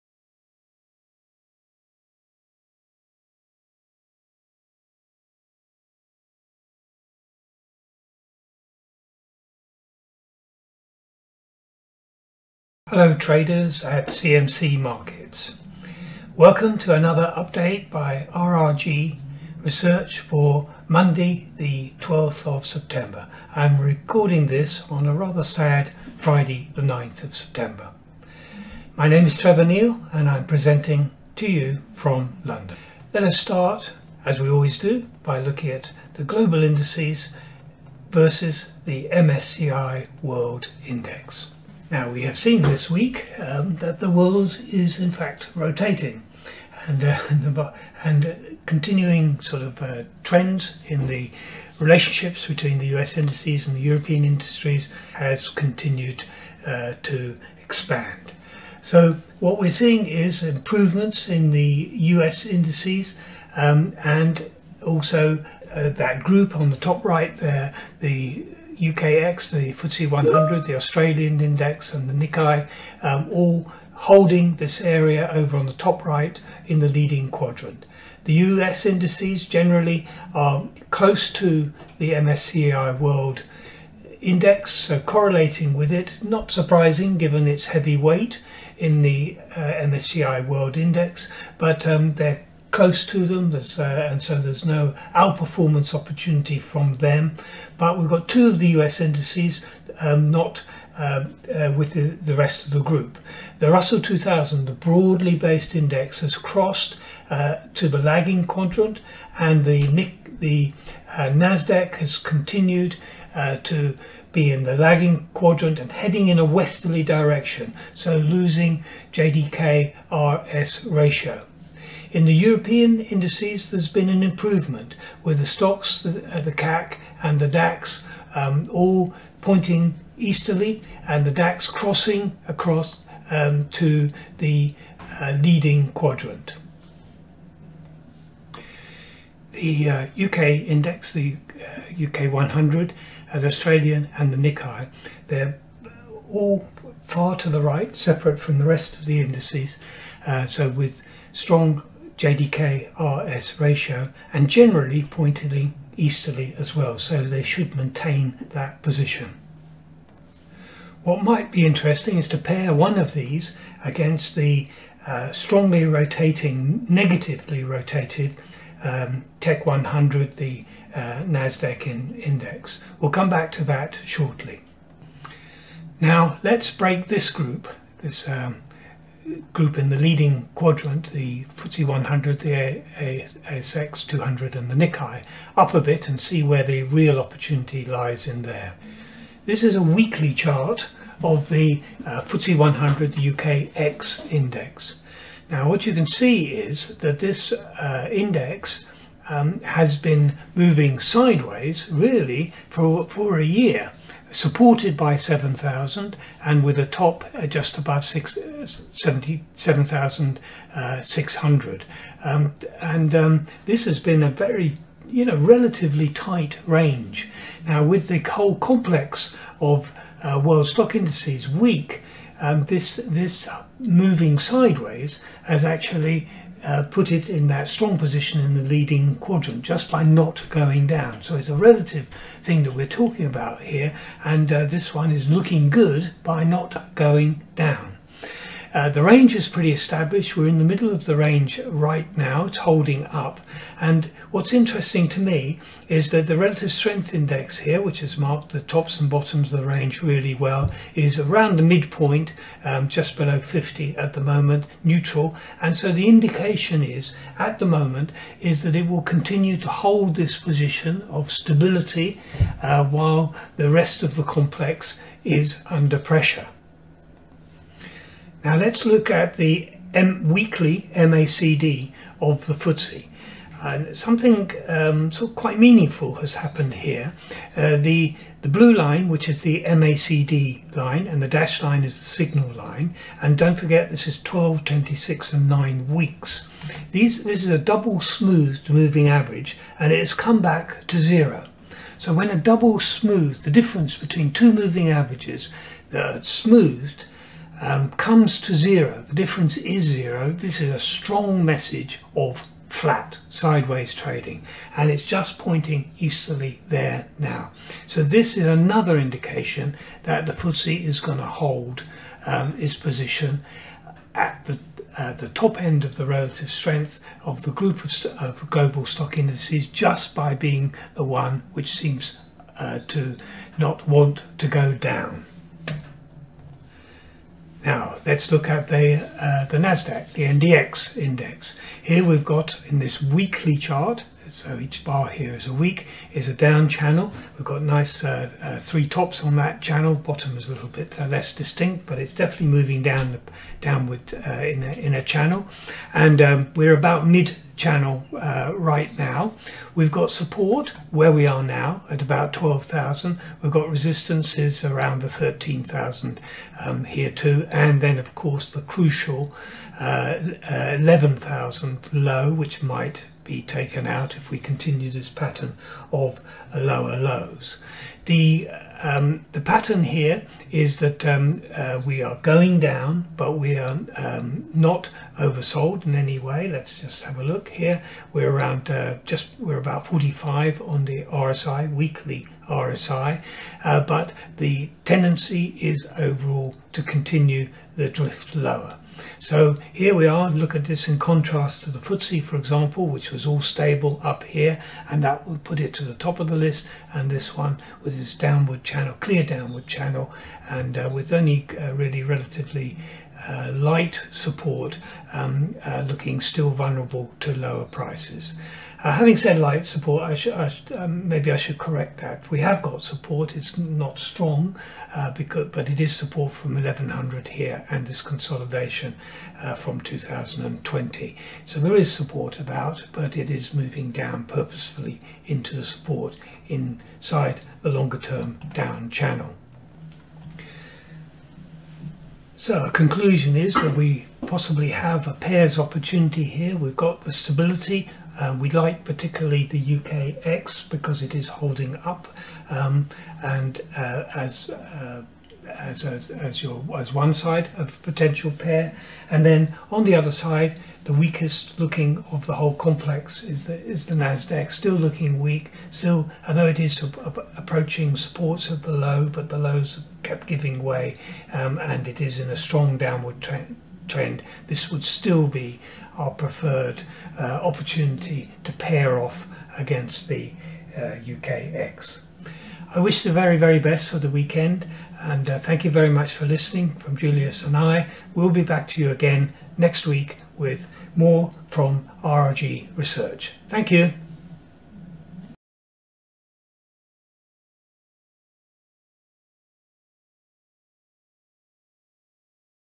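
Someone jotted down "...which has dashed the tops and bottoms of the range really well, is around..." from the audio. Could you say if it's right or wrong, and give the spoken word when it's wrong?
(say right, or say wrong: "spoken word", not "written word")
wrong: "marked", not "dashed".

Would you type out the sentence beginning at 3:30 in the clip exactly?
Uh, um, and um, this has been a very, you know, relatively tight range.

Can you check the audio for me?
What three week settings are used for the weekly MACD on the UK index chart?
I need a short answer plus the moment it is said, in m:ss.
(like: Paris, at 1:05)
12, 26, and 9, at 4:44.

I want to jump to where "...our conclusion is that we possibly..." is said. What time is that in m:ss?
7:12.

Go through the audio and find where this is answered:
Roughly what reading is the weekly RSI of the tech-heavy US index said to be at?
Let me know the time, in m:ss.
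6:19.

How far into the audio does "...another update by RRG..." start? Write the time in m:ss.
0:16.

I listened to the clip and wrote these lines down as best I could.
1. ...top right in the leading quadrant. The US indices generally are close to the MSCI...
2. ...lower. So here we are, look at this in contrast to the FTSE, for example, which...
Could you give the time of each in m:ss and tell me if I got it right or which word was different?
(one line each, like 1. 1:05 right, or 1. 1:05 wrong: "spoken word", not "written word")
1. 1:15 right
2. 6:28 right.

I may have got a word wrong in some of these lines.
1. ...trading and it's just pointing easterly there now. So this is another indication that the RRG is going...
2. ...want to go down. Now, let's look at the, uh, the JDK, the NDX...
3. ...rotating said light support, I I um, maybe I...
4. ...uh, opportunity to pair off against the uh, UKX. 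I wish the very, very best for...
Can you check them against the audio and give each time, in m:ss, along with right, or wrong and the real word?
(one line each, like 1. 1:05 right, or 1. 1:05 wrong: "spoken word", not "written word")
1. 5:03 wrong: "FTSE", not "RRG"
2. 5:23 wrong: "NASDAQ", not "JDK"
3. 6:48 wrong: "having", not "rotating"
4. 7:47 right.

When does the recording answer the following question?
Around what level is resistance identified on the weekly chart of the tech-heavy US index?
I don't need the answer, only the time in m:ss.
5:55.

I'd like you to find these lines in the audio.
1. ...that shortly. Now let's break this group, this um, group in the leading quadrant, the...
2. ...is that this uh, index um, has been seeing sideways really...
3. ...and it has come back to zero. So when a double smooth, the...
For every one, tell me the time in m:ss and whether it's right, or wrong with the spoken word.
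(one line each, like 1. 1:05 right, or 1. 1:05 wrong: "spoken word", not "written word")
1. 2:53 right
2. 3:16 wrong: "moving", not "seeing"
3. 4:49 right.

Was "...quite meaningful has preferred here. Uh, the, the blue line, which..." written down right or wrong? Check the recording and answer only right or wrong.
wrong.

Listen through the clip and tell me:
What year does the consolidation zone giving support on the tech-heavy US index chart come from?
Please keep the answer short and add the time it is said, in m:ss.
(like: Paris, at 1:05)
2020, at 6:59.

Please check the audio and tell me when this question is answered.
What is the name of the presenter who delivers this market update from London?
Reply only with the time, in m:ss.
0:29.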